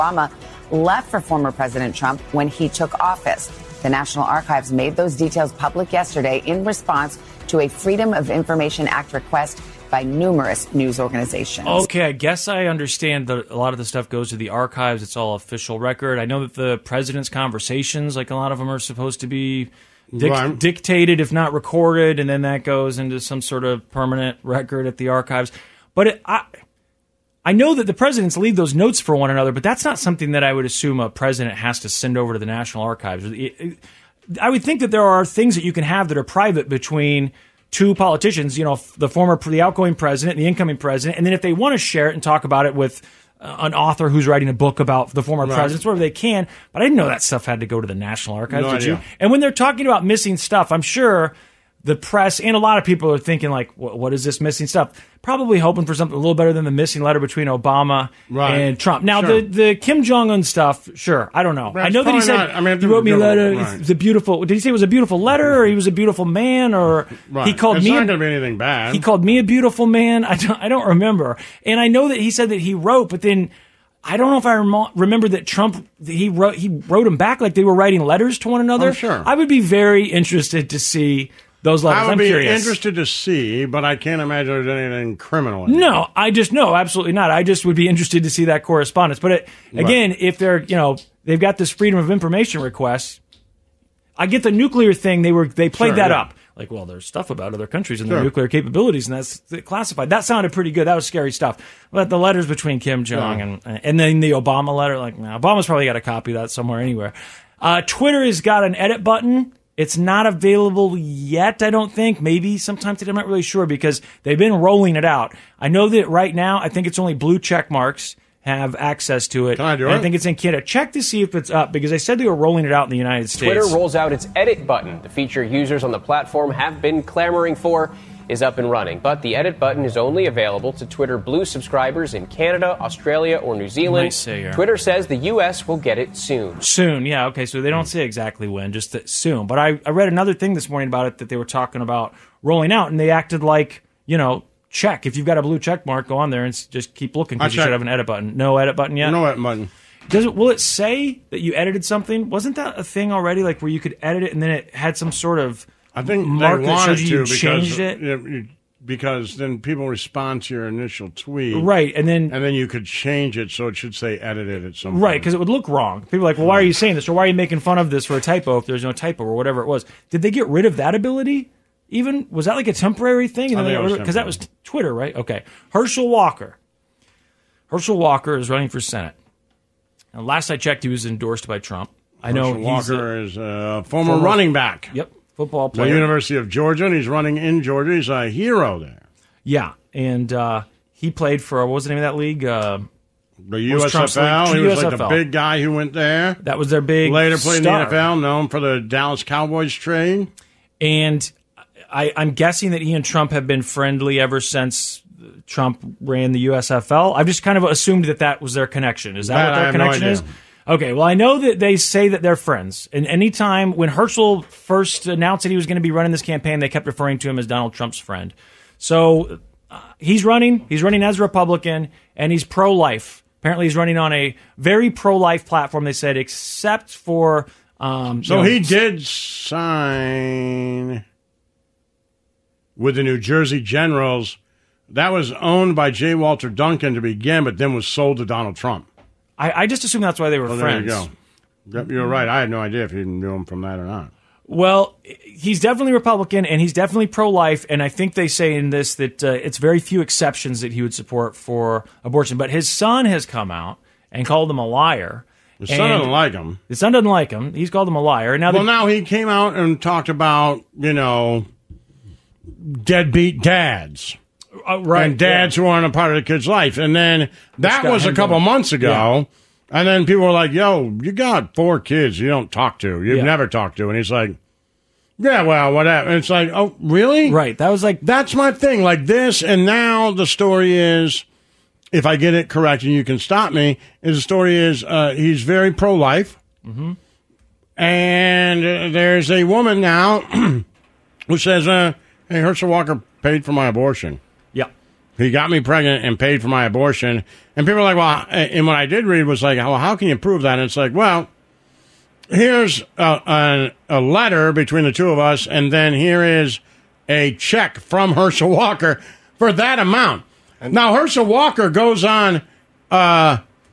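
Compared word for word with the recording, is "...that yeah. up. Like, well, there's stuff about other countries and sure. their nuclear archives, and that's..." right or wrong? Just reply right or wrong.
wrong.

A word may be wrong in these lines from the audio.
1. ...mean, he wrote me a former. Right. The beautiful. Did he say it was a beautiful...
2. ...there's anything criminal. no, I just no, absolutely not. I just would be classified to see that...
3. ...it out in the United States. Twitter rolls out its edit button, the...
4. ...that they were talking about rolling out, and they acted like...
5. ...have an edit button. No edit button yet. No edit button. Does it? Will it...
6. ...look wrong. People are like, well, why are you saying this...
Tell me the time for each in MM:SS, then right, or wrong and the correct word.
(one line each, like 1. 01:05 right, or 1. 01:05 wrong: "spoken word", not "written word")
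1. 01:02 wrong: "letter", not "former"
2. 01:24 wrong: "interested", not "classified"
3. 02:02 right
4. 02:21 right
5. 02:27 right
6. 02:45 right.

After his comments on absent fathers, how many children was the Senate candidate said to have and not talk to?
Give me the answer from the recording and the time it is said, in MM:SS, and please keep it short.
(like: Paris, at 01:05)
4, at 04:31.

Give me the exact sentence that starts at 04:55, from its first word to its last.
He got me pregnant and paid for my abortion.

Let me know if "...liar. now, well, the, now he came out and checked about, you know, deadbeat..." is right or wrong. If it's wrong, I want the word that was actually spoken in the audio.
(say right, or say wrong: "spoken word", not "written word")
wrong: "talked", not "checked".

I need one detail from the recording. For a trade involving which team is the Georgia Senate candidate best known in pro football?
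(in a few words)
Dallas Cowboys.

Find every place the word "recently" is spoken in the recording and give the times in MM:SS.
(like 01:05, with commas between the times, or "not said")
not said.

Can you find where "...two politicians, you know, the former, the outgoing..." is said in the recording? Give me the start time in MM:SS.
00:37.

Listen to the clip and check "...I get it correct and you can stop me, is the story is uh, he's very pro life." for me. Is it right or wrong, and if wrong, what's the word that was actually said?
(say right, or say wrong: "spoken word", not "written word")
right.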